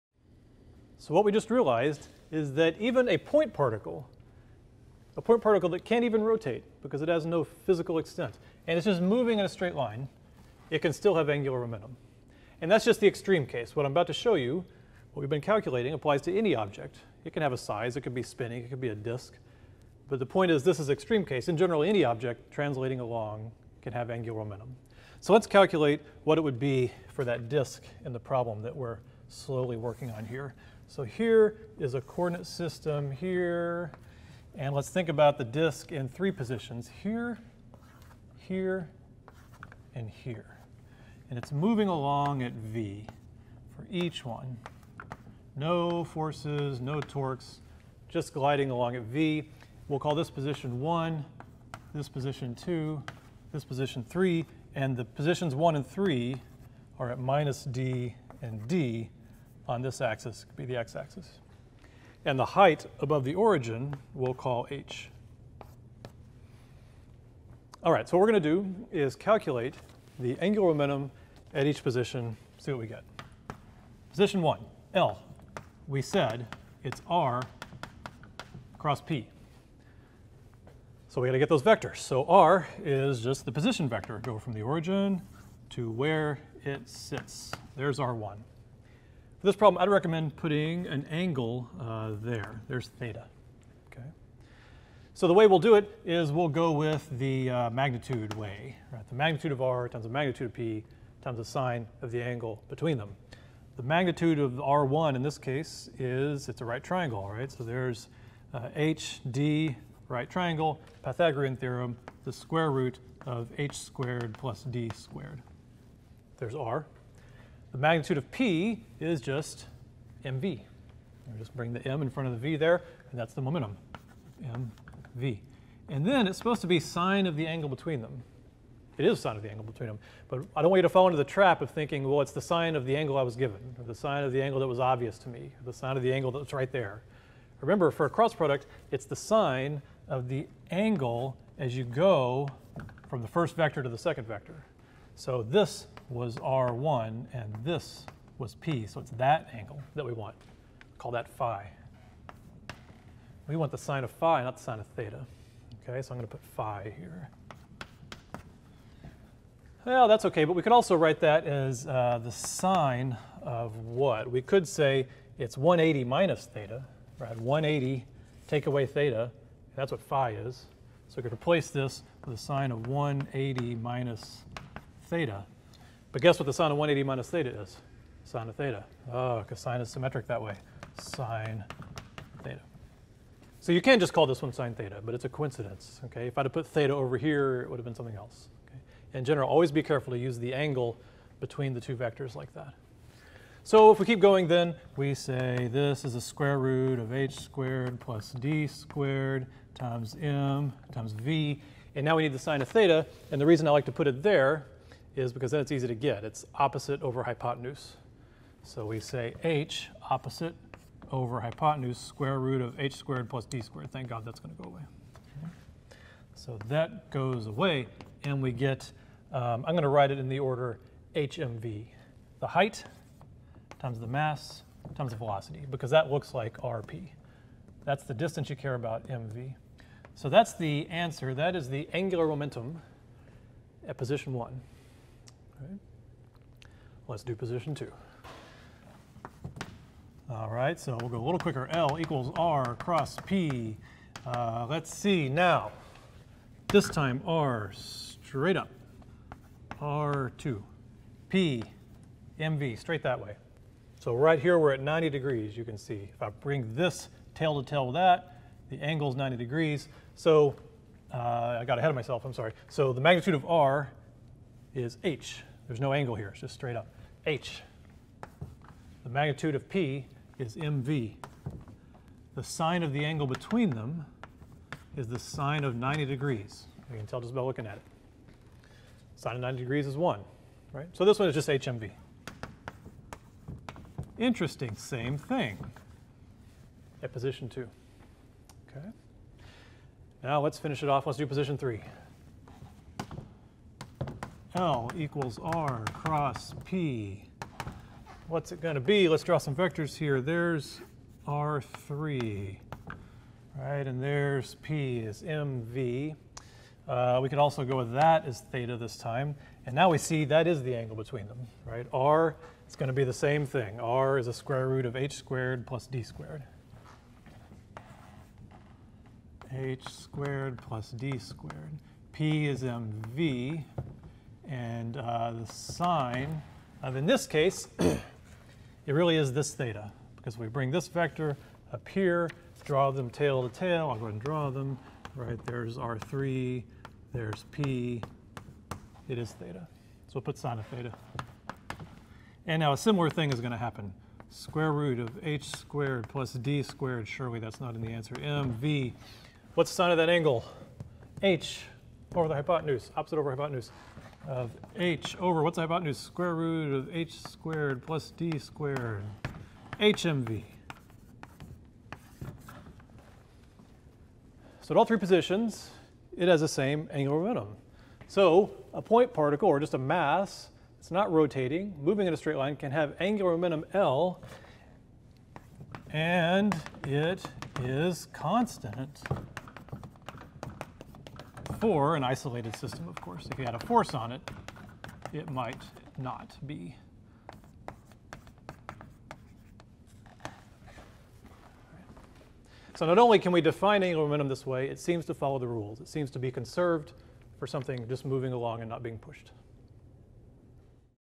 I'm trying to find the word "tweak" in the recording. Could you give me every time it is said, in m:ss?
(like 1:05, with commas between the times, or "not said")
not said.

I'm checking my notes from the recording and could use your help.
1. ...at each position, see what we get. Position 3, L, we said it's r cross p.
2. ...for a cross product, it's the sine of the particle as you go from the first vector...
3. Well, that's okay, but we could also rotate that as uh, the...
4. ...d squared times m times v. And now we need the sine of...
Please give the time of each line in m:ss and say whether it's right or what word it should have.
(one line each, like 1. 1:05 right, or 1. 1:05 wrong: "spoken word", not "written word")
1. 1:11 wrong: "1", not "3"
2. 2:17 wrong: "angle", not "particle"
3. 2:39 wrong: "write", not "rotate"
4. 3:18 right.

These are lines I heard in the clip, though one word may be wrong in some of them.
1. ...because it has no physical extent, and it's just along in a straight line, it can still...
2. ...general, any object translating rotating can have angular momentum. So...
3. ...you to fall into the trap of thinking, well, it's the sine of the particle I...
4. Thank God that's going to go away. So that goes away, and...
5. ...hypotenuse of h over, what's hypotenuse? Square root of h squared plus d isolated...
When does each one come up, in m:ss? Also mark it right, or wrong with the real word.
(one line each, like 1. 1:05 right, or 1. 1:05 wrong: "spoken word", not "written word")
1. 0:06 wrong: "moving", not "along"
2. 0:21 wrong: "along", not "rotating"
3. 2:10 wrong: "angle", not "particle"
4. 3:33 right
5. 5:53 wrong: "squared", not "isolated".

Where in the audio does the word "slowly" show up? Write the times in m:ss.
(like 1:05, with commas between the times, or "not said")
0:29.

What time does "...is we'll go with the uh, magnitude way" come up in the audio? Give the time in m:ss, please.
1:36.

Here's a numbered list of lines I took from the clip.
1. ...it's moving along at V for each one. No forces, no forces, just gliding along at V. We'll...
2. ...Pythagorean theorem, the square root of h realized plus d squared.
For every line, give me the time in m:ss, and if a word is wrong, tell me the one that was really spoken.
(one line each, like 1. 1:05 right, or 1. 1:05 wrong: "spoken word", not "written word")
1. 0:41 wrong: "torques", not "forces"
2. 1:51 wrong: "squared", not "realized".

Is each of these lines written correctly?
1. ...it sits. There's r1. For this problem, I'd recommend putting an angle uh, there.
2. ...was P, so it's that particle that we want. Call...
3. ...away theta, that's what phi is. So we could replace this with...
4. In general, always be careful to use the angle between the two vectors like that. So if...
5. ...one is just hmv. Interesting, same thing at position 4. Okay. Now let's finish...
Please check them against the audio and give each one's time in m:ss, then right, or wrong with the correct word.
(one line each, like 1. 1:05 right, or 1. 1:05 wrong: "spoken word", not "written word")
1. 1:26 right
2. 2:28 wrong: "angle", not "particle"
3. 2:48 right
4. 3:09 right
5. 4:41 wrong: "2", not "4".